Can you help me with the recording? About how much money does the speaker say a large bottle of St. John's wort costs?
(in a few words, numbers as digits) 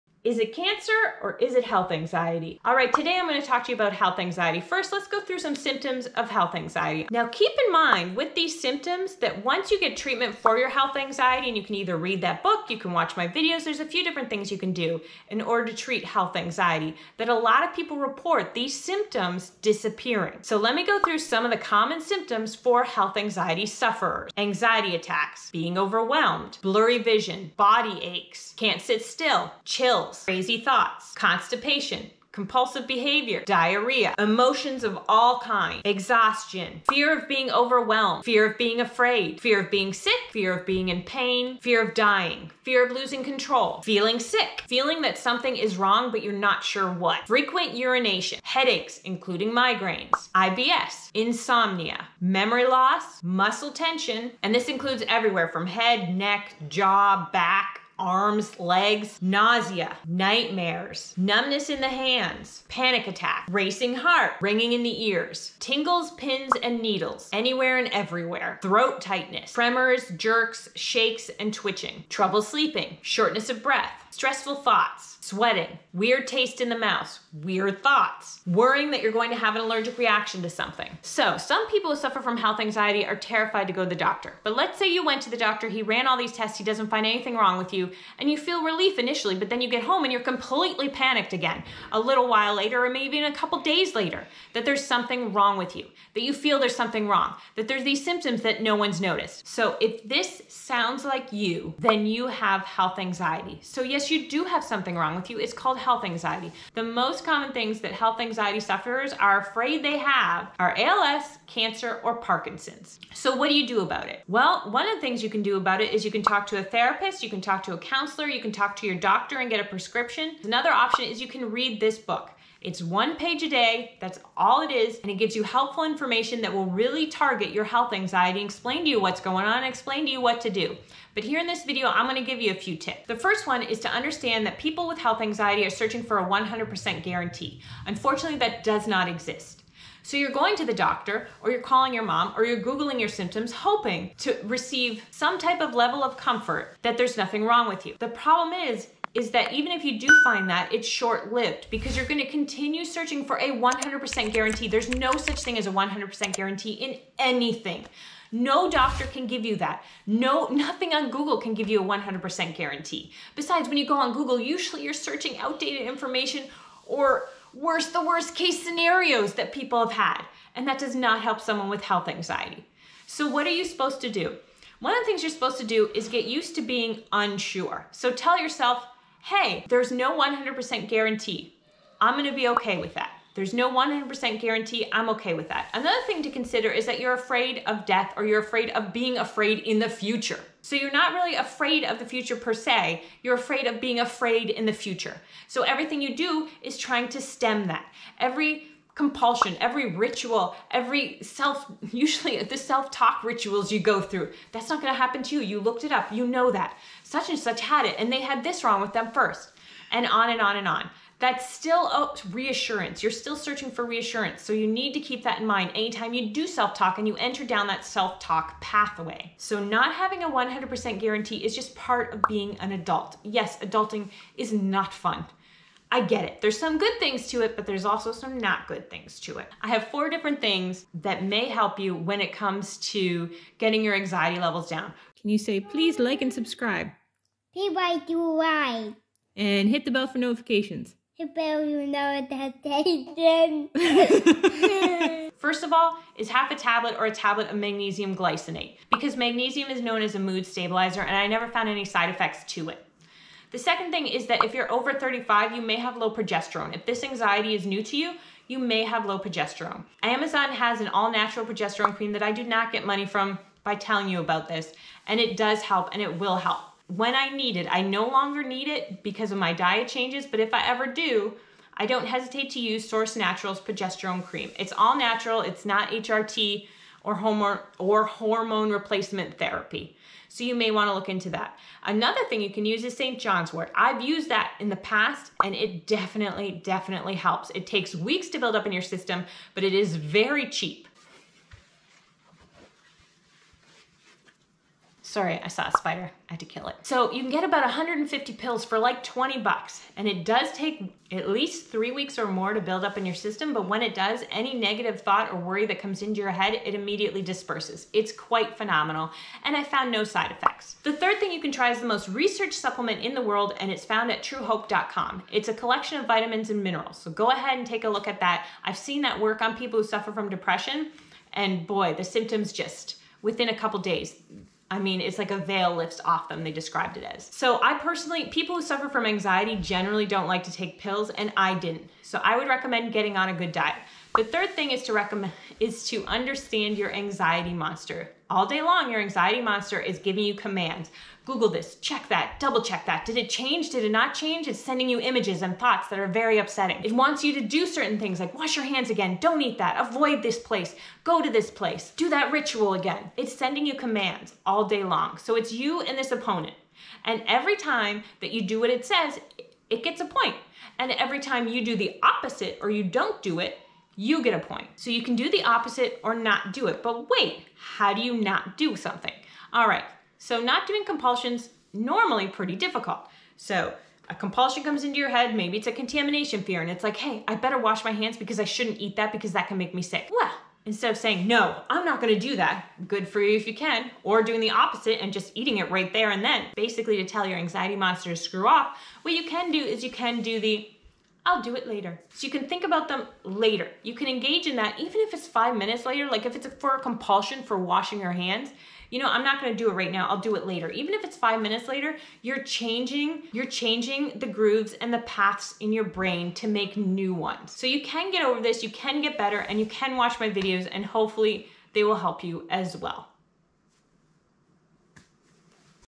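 20 bucks.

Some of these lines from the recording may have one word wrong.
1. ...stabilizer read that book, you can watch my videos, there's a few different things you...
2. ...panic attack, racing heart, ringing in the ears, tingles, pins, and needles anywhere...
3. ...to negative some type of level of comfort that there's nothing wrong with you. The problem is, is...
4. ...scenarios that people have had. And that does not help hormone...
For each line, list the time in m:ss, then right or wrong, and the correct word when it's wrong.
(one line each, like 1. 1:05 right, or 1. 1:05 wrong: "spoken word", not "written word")
1. 0:11 wrong: "either", not "stabilizer"
2. 1:02 right
3. 2:24 wrong: "receive", not "negative"
4. 2:48 wrong: "someone", not "hormone".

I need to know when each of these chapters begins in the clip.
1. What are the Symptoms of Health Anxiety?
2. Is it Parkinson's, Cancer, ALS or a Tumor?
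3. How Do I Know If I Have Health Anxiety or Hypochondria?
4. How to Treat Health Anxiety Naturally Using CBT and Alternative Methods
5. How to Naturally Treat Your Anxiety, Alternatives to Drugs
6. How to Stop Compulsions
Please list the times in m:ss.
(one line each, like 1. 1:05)
1. 0:25
2. 0:36
3. 1:20
4. 1:54
5. 3:50
6. 5:34.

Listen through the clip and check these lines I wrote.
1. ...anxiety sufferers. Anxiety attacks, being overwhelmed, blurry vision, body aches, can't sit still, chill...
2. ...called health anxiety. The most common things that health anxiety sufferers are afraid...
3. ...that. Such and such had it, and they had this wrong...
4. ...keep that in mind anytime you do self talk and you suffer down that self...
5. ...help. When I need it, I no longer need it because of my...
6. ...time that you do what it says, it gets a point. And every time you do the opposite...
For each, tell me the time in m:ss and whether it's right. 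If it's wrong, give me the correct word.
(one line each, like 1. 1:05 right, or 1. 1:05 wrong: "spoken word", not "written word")
1. 0:23 right
2. 1:45 right
3. 3:26 right
4. 3:34 wrong: "enter", not "suffer"
5. 4:26 right
6. 5:57 right.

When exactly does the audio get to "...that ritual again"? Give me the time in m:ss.
5:52.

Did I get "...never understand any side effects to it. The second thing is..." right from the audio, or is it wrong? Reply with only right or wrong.
wrong.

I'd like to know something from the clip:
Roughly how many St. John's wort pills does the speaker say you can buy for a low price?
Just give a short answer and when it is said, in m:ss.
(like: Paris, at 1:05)
150, at 4:57.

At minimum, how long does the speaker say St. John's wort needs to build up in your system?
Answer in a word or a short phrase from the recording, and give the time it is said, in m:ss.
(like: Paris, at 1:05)
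Three weeks, at 5:01.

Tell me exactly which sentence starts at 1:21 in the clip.
So, some people who suffer from health anxiety are terrified to go to the doctor.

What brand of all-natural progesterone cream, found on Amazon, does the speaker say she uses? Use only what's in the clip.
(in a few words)
Source Naturals.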